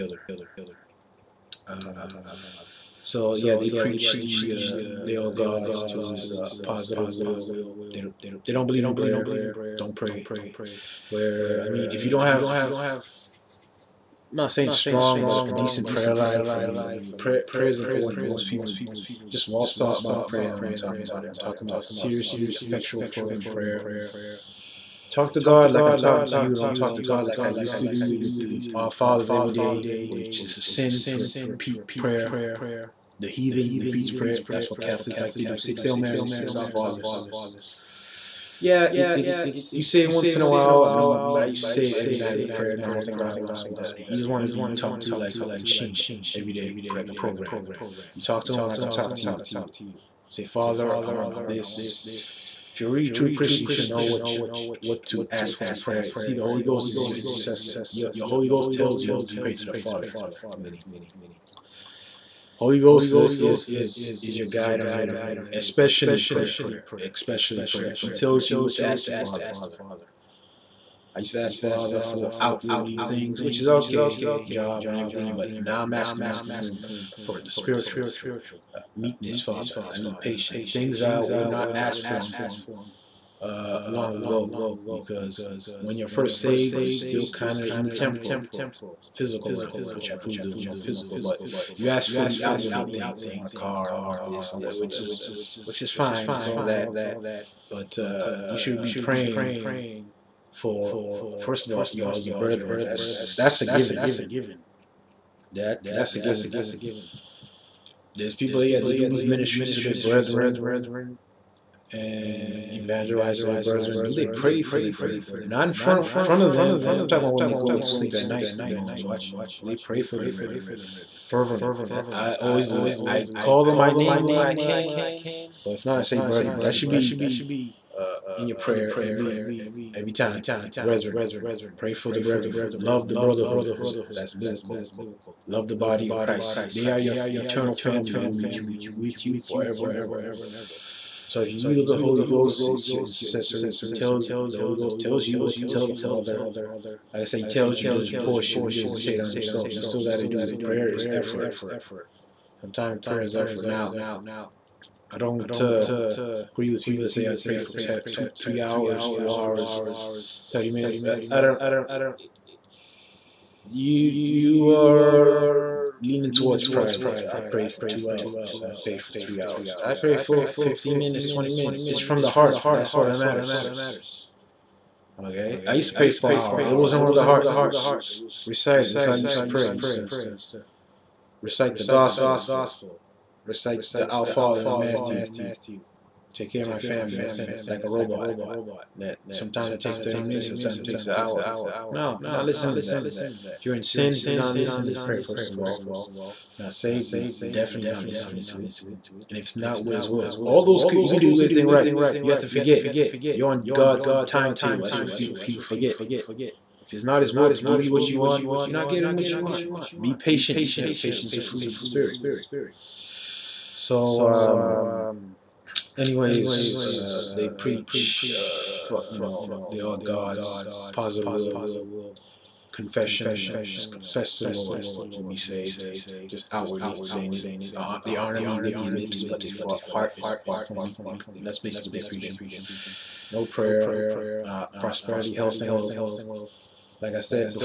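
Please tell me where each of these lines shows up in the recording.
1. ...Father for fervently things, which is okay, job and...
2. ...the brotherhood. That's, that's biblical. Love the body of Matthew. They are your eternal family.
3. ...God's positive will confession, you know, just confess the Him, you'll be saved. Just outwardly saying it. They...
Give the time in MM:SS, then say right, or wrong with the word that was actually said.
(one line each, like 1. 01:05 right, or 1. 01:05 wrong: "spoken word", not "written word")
1. 01:11 wrong: "outwardly", not "fervently"
2. 02:13 wrong: "Christ", not "Matthew"
3. 03:39 wrong: "Lord", not "Him".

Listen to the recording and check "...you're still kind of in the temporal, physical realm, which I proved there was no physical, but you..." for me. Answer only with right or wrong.
right.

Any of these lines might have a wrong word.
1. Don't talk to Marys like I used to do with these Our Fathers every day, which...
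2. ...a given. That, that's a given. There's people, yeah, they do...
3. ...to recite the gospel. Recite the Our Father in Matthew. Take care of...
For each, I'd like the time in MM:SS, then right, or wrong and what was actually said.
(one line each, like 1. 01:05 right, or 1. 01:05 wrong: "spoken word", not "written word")
1. 00:26 wrong: "God", not "Marys"
2. 01:43 right
3. 02:59 right.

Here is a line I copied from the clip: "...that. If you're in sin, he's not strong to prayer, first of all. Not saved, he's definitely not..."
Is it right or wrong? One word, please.
wrong.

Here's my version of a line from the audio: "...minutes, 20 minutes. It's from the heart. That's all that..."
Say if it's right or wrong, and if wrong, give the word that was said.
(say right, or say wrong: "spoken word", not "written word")
right.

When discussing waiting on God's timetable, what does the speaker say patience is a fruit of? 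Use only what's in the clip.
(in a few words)
The Spirit.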